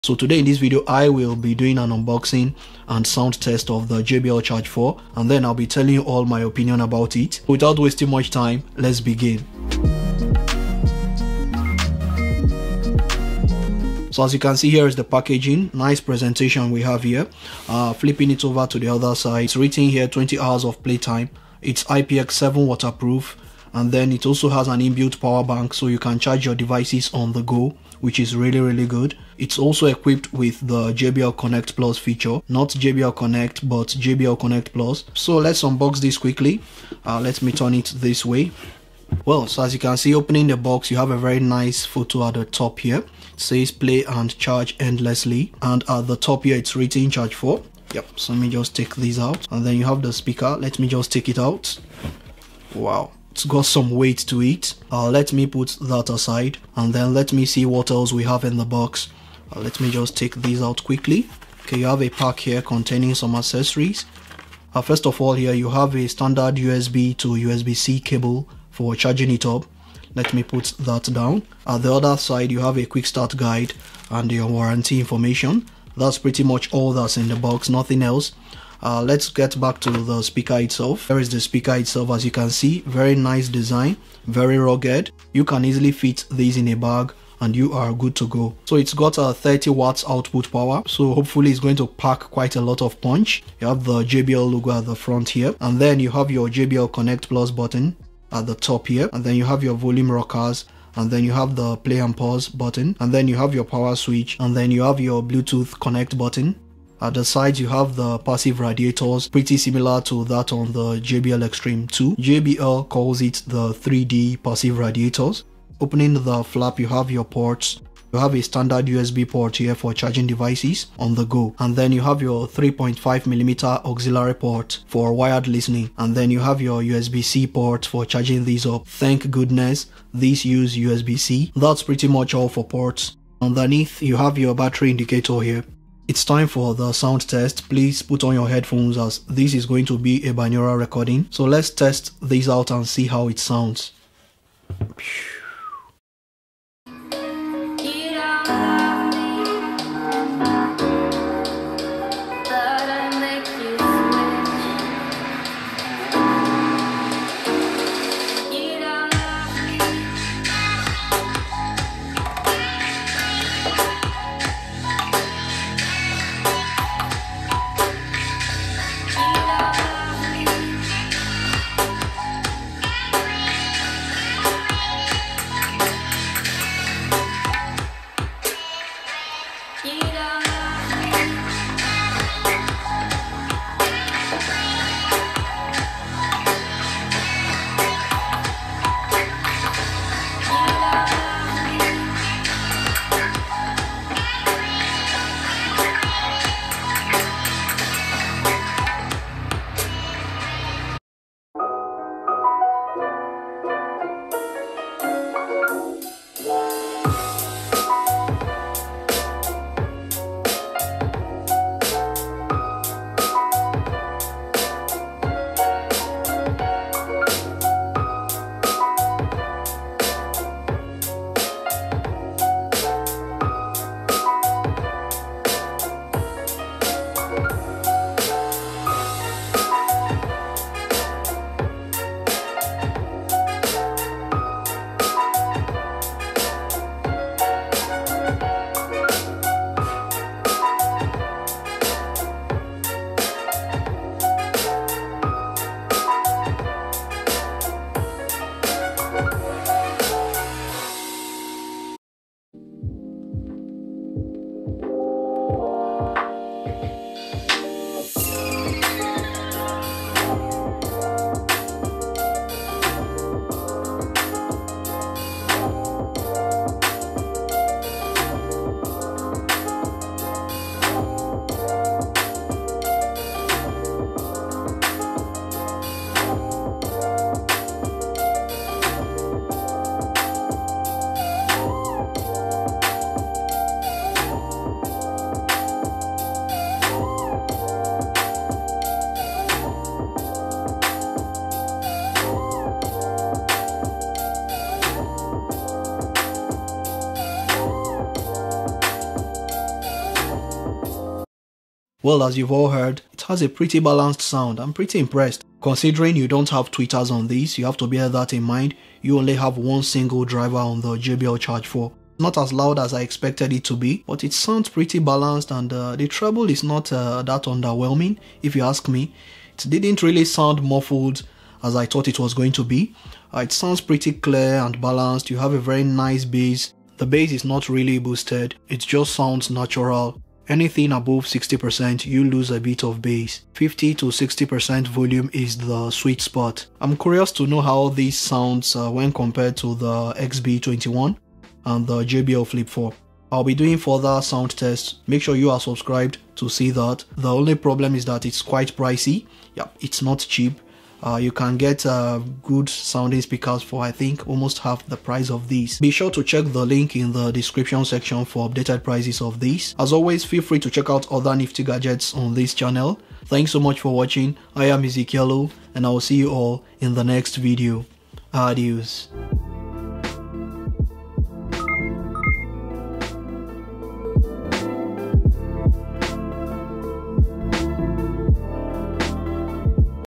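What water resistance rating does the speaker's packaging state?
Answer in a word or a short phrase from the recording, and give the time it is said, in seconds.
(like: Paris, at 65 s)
IPX7, at 21 s.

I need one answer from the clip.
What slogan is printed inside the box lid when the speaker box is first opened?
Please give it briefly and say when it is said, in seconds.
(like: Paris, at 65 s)
Play and charge endlessly, at 43 s.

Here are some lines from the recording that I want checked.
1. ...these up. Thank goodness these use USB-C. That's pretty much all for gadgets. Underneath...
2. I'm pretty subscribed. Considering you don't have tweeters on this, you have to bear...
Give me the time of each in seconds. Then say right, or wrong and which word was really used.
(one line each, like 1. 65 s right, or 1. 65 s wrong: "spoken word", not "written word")
1. 128 s wrong: "ports", not "gadgets"
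2. 304 s wrong: "impressed", not "subscribed".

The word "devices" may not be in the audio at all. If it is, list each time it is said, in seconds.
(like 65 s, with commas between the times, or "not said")
26 s, 120 s.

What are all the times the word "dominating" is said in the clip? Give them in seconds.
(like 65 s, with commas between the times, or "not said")
not said.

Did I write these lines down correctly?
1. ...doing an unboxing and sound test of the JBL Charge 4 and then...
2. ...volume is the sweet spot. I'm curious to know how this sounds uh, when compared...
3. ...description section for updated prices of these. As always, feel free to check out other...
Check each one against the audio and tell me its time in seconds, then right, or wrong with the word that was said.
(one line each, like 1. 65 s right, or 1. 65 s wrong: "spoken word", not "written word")
1. 1 s right
2. 334 s right
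3. 357 s right.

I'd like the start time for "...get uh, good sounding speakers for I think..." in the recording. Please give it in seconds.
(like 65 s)
351 s.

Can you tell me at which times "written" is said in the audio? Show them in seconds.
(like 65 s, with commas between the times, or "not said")
19 s, 46 s.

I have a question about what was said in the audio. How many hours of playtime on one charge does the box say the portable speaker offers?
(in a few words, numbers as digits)
20 hours.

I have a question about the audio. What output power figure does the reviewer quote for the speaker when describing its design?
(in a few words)
30 watts.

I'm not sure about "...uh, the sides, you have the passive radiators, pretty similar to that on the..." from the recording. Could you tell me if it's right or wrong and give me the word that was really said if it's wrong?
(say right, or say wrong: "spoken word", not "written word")
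right.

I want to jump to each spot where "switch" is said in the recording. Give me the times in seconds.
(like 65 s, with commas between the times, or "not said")
103 s.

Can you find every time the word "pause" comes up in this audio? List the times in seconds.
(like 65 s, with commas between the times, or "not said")
102 s.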